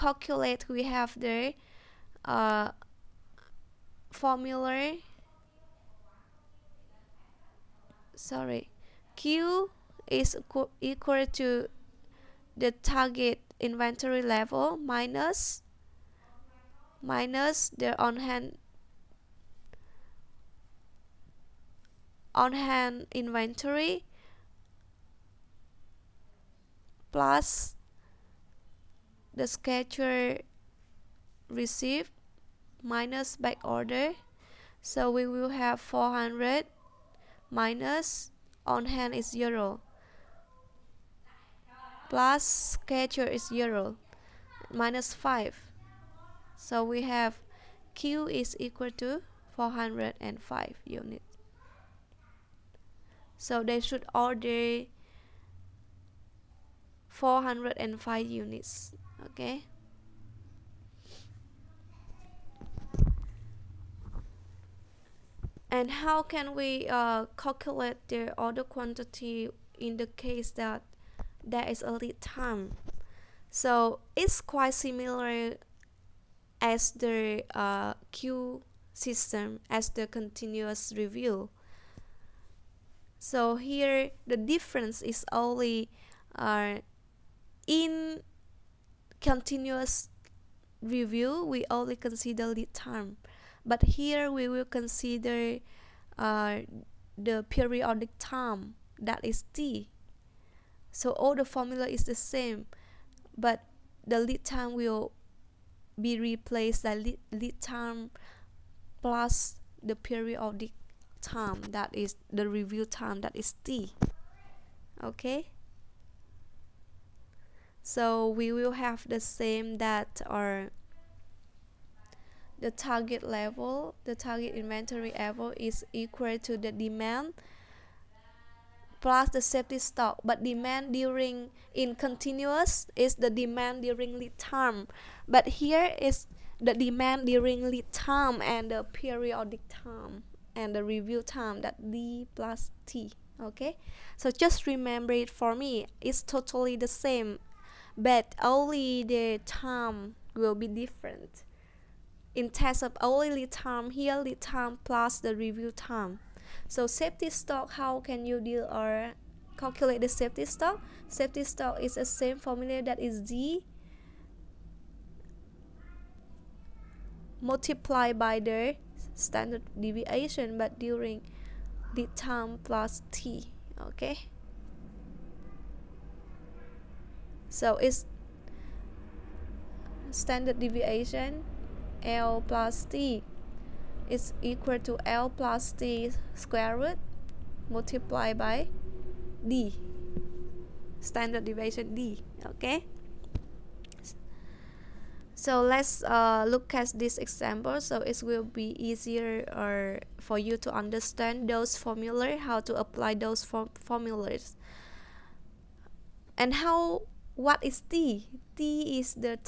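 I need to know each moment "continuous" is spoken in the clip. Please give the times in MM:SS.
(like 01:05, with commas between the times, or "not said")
01:20, 01:29, 02:11.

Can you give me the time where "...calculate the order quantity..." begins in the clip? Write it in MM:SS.
01:07.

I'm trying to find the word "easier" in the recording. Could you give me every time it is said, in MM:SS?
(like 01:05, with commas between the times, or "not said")
03:18.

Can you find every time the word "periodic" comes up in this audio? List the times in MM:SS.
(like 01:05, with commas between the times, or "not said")
01:37, 01:49, 02:18.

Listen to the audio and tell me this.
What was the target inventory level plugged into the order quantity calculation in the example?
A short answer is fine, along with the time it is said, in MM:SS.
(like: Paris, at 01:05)
400, at 00:35.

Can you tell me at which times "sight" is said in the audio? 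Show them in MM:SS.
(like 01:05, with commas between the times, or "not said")
not said.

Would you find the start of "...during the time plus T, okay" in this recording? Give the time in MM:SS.
02:50.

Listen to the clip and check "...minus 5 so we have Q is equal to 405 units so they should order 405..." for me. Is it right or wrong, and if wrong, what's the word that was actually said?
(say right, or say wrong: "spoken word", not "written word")
right.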